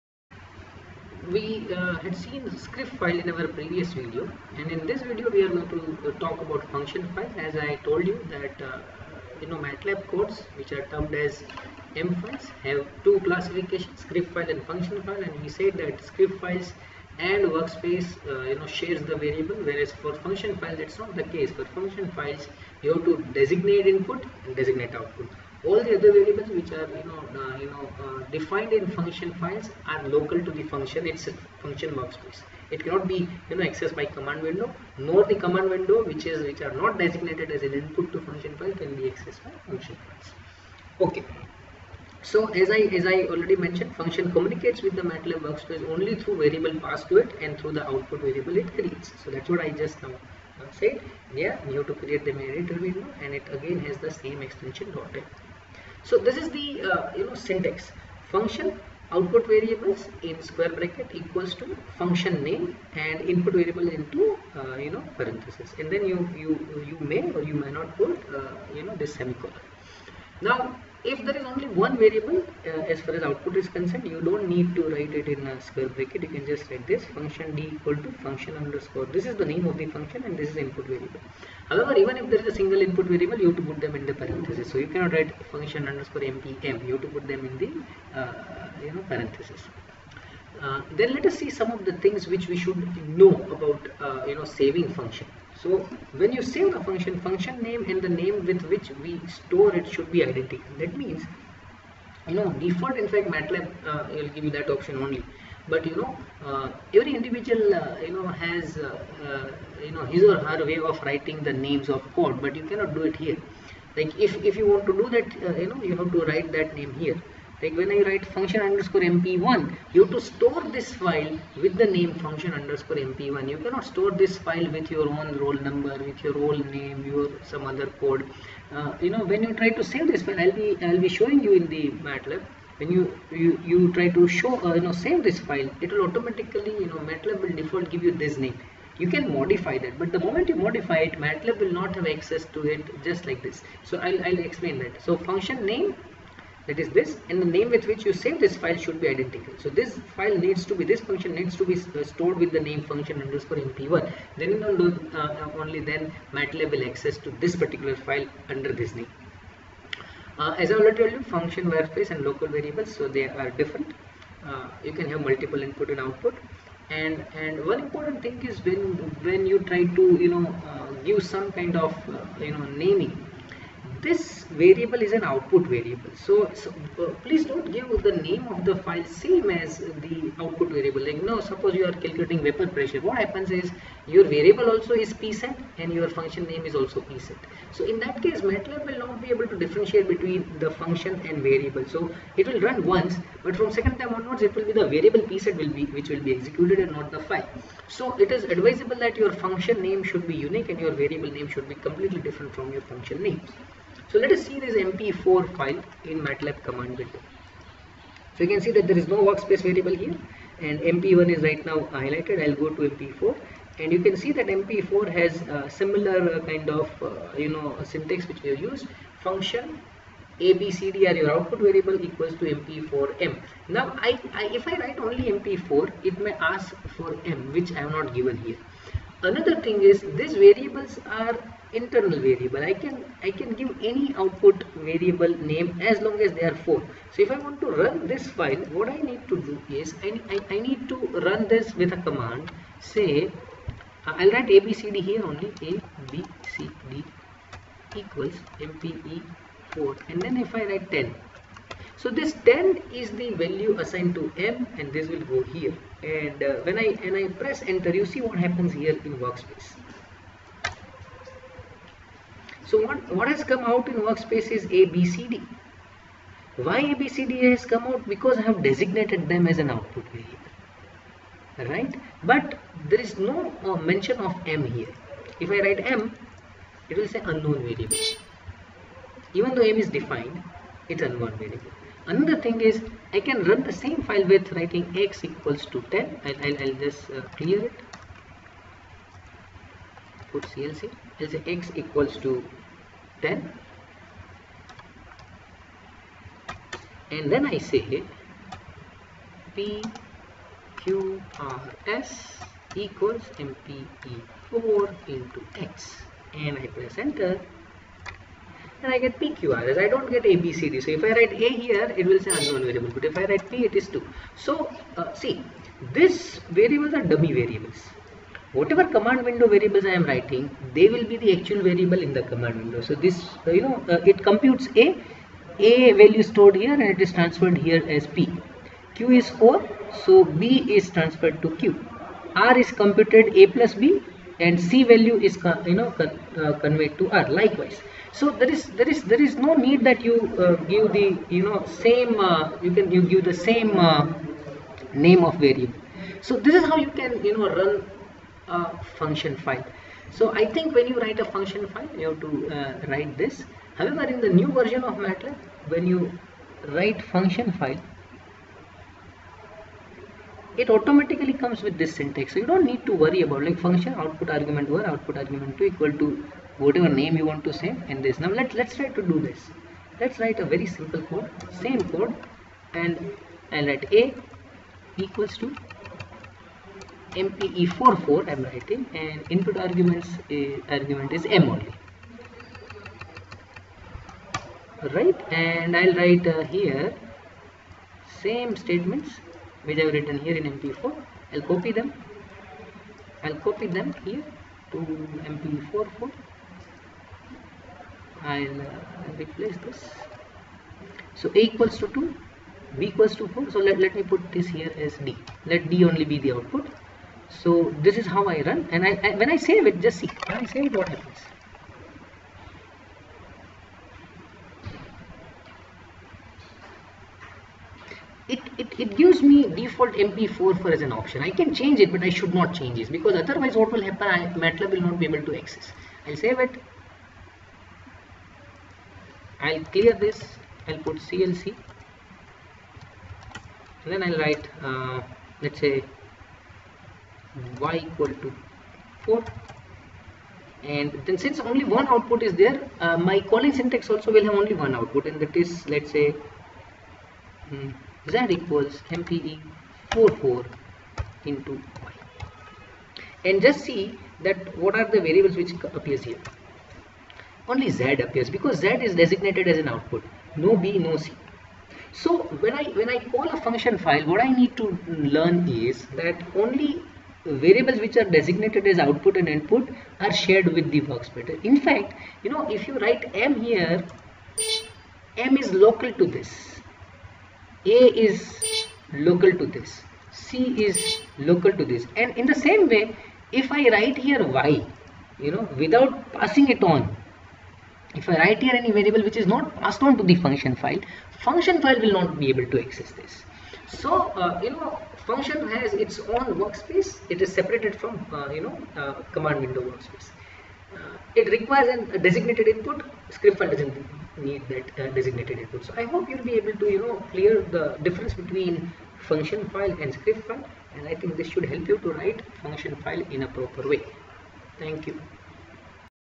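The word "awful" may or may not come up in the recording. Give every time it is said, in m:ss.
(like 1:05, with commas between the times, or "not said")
not said.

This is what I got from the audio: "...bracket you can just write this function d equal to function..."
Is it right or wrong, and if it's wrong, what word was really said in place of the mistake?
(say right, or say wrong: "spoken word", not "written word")
right.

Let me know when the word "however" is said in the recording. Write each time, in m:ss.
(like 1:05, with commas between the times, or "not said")
1:21, 5:53.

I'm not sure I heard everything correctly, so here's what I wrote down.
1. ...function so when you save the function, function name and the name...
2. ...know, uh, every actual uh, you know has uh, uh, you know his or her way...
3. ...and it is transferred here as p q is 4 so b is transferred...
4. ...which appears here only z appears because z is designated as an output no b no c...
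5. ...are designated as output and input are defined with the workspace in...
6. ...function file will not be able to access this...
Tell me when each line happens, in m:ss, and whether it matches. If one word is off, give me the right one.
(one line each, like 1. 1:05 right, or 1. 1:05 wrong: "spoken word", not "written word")
1. 1:35 right
2. 1:45 wrong: "individual", not "actual"
3. 5:26 right
4. 7:35 right
5. 7:47 wrong: "shared", not "defined"
6. 8:11 right.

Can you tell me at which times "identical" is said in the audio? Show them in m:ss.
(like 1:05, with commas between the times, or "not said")
1:40, 2:29.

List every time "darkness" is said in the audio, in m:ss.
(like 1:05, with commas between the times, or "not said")
not said.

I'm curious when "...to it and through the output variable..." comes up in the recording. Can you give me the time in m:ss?
0:47.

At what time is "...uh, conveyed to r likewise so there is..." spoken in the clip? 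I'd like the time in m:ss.
5:36.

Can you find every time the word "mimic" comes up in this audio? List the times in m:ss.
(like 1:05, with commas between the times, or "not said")
not said.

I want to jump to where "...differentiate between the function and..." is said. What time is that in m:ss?
3:09.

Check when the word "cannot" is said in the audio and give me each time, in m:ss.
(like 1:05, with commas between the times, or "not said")
0:32, 1:24, 1:52, 2:03.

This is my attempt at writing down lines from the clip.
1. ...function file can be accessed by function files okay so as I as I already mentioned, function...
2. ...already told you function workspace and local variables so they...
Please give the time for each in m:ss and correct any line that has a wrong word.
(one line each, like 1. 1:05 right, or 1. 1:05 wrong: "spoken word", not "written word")
1. 0:38 right
2. 2:40 right.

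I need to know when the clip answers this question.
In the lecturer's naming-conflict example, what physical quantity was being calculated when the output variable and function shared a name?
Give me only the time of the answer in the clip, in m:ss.
3:02.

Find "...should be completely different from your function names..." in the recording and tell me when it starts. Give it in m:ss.
3:21.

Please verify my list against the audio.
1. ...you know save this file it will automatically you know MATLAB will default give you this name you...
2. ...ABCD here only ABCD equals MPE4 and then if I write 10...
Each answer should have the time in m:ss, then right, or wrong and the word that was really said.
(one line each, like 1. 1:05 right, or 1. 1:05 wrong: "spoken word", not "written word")
1. 2:14 right
2. 4:04 right.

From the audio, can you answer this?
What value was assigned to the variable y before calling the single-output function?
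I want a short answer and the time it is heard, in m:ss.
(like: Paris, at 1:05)
4, at 7:17.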